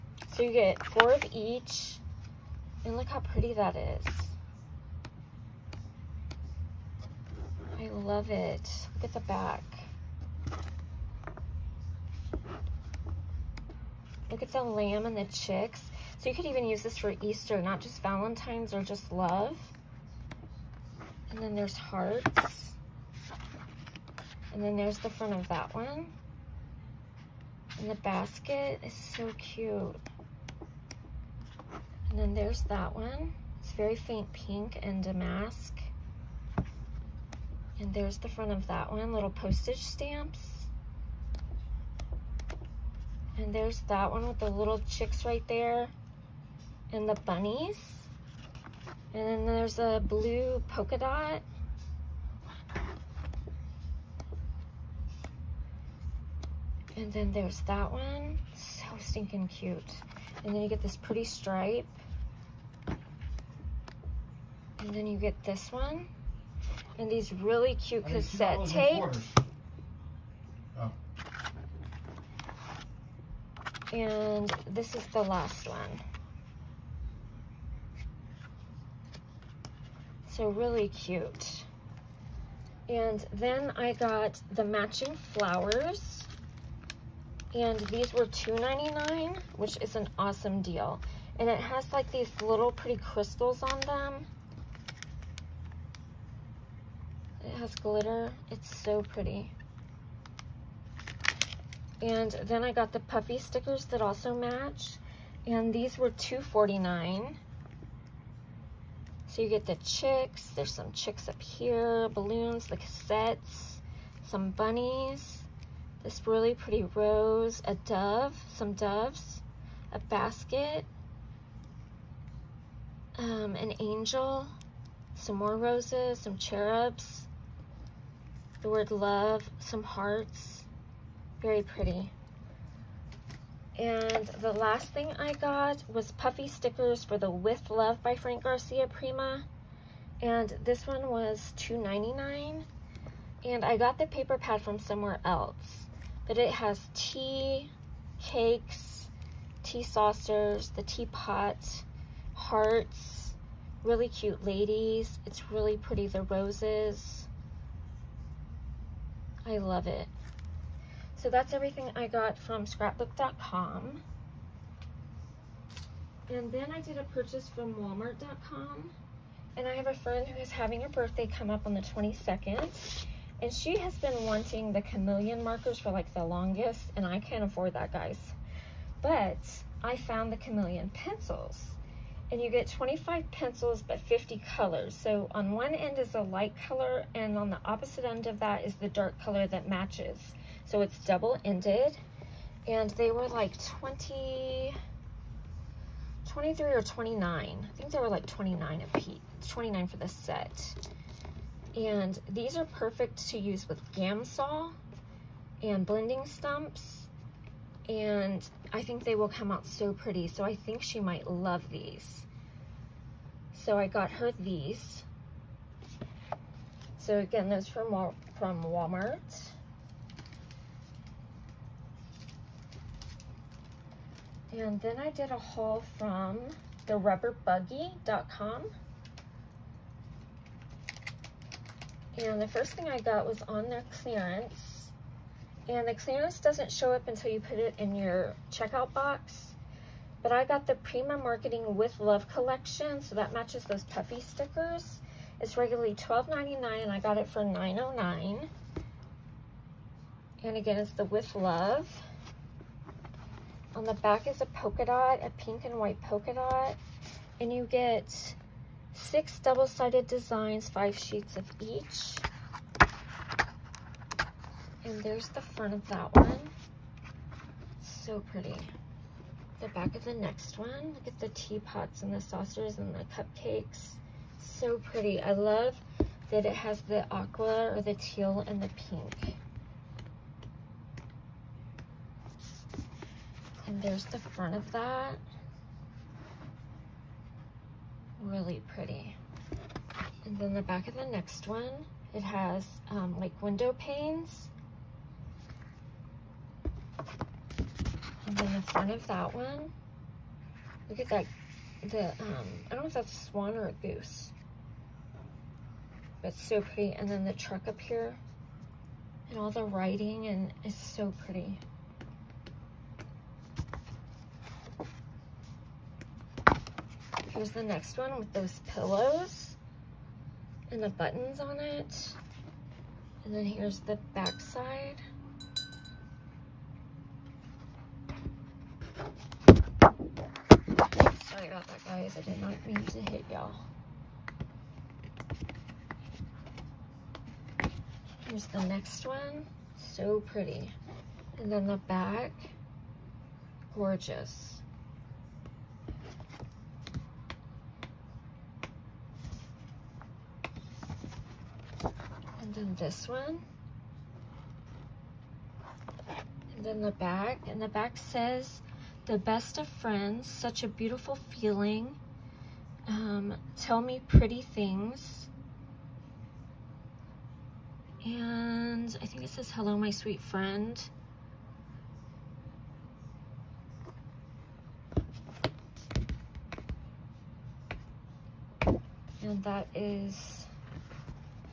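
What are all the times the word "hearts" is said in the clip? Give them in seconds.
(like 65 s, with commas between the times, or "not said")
21 s, 129 s, 152 s.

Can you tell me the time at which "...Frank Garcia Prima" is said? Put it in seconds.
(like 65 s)
138 s.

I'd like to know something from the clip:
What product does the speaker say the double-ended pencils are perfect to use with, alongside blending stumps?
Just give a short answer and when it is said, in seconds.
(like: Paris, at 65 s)
Gamsol, at 203 s.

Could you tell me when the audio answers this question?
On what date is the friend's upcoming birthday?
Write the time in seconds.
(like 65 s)
171 s.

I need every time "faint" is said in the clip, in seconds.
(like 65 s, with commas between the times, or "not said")
33 s.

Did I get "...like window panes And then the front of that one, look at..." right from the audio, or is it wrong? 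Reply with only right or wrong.
right.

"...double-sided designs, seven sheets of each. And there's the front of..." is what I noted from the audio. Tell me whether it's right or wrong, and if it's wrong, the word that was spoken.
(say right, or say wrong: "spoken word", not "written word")
wrong: "five", not "seven".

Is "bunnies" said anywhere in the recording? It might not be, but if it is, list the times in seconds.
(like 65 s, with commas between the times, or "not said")
47 s, 114 s.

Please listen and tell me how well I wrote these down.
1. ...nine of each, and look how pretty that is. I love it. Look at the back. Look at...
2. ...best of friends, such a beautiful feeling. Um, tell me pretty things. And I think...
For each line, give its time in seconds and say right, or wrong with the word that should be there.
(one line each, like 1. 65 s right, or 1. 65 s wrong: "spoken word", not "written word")
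1. 0 s wrong: "four", not "nine"
2. 359 s right.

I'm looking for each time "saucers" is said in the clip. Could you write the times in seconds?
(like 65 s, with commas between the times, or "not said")
149 s, 272 s.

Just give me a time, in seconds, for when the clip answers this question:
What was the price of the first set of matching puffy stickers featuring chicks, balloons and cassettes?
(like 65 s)
106 s.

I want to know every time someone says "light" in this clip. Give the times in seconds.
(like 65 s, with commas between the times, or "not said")
186 s.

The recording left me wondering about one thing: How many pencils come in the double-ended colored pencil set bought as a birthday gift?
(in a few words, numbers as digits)
25.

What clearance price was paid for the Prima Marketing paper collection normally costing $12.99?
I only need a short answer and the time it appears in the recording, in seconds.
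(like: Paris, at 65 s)
$9.09, at 247 s.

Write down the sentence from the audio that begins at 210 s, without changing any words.
So I think she might love these.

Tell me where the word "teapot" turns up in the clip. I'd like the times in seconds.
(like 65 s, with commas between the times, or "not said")
150 s, 271 s.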